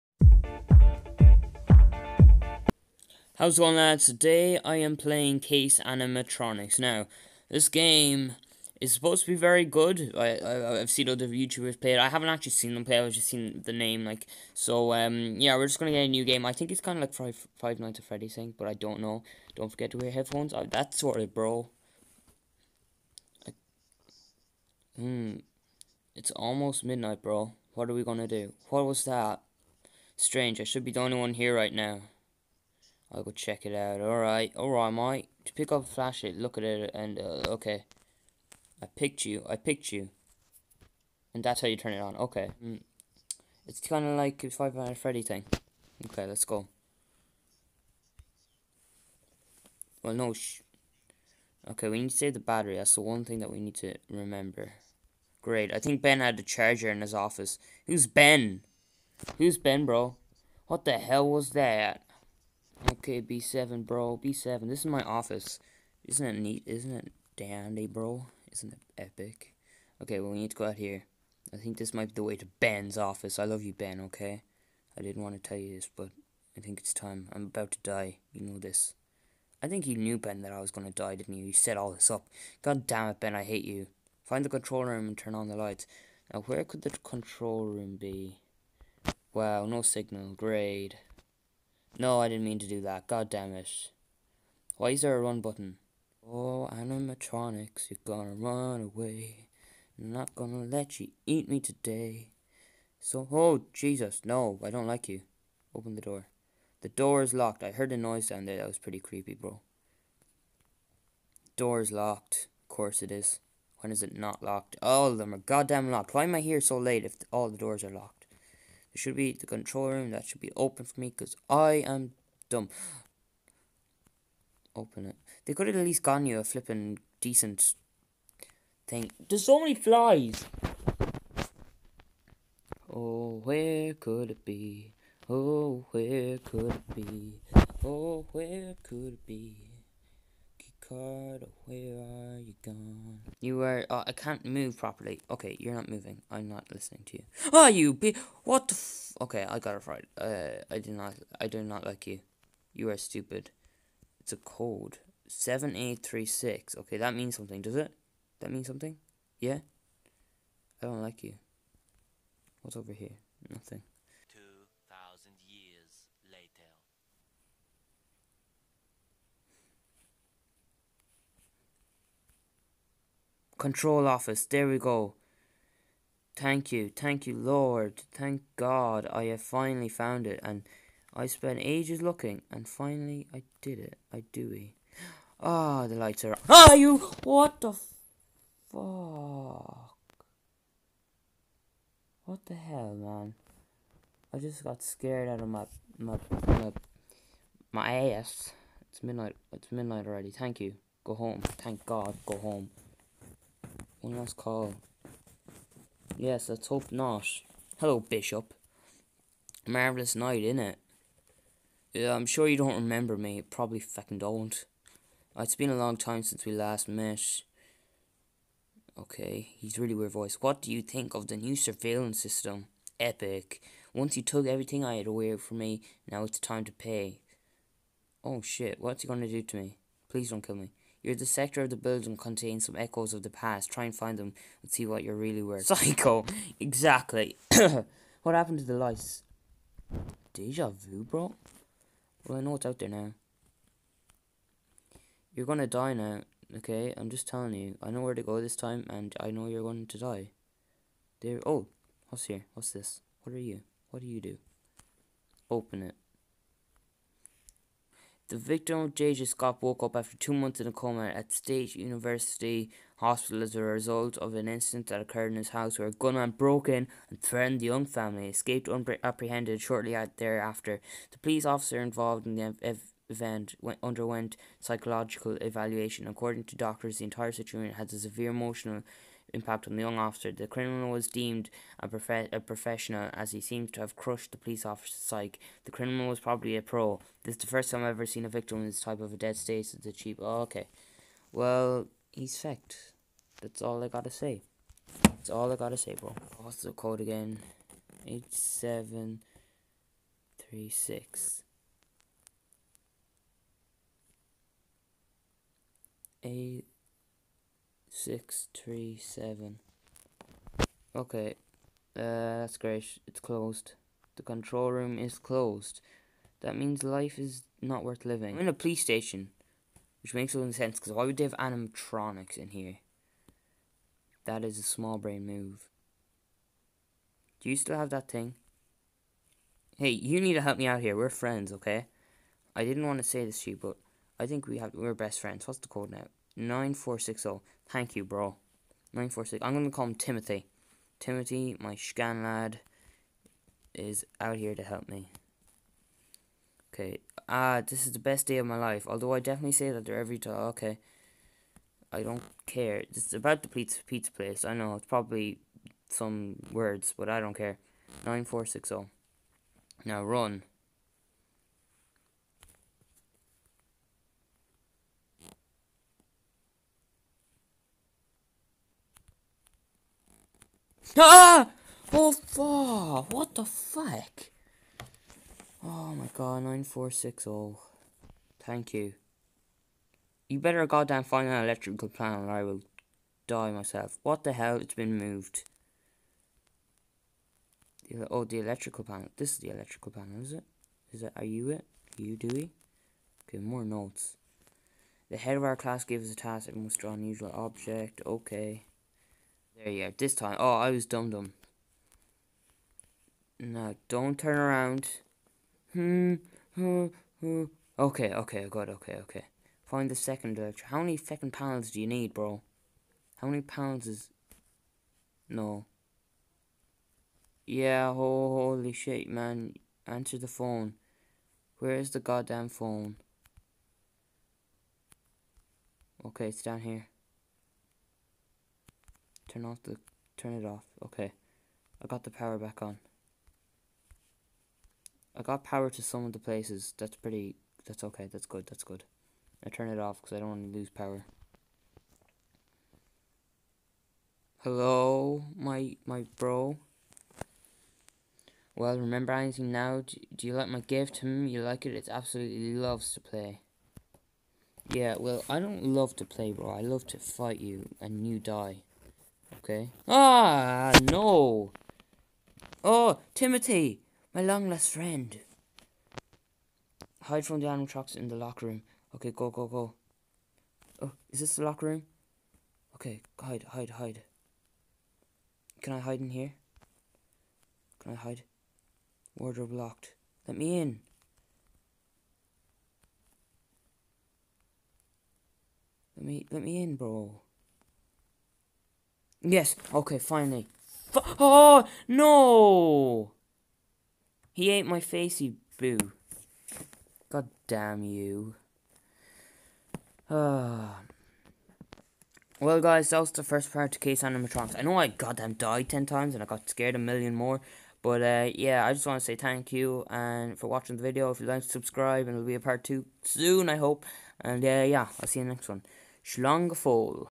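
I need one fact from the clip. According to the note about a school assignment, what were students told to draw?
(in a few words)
an unusual object.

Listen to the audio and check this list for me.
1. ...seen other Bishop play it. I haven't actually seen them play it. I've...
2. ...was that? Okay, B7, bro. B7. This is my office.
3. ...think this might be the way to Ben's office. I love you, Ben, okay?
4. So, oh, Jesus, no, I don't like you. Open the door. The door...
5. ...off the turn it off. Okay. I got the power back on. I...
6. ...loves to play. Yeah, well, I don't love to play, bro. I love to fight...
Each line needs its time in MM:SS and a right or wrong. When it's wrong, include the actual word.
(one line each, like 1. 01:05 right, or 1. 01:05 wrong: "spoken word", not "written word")
1. 00:10 wrong: "YouTubers", not "Bishop"
2. 01:01 right
3. 01:11 right
4. 01:42 right
5. 07:09 right
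6. 07:32 right.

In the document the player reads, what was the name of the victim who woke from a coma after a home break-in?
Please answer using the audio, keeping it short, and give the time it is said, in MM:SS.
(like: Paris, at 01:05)
JJ Scott, at 04:18.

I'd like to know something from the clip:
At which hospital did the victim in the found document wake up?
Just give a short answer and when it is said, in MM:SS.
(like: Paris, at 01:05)
State University Hospital, at 04:21.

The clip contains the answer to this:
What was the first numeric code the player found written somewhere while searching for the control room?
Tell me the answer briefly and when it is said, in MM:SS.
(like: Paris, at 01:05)
7836, at 02:35.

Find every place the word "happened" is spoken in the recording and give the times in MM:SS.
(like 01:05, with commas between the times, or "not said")
03:58.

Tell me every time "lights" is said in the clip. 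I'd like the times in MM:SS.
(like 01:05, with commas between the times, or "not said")
01:25, 03:05, 03:58.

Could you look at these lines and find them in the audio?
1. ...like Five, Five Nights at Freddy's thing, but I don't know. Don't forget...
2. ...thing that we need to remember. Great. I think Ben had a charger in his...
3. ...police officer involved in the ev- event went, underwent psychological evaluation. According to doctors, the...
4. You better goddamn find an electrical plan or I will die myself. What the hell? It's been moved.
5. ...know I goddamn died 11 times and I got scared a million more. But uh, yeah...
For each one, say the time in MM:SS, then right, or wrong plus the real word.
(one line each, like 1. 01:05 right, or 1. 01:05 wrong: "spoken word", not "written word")
1. 00:17 right
2. 00:53 right
3. 04:31 right
4. 06:20 right
5. 08:24 wrong: "10", not "11".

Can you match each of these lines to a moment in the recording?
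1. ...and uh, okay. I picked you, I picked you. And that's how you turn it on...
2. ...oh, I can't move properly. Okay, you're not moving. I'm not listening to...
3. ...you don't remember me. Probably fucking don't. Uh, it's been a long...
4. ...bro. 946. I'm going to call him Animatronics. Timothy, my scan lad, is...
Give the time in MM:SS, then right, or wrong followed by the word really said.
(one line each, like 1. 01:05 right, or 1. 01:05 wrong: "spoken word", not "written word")
1. 00:36 right
2. 02:23 right
3. 03:32 right
4. 05:38 wrong: "Timothy", not "Animatronics".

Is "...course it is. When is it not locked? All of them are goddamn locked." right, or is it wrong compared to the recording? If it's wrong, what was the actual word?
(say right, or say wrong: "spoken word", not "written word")
right.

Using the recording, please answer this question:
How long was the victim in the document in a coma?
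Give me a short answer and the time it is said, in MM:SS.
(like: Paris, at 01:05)
two months, at 04:20.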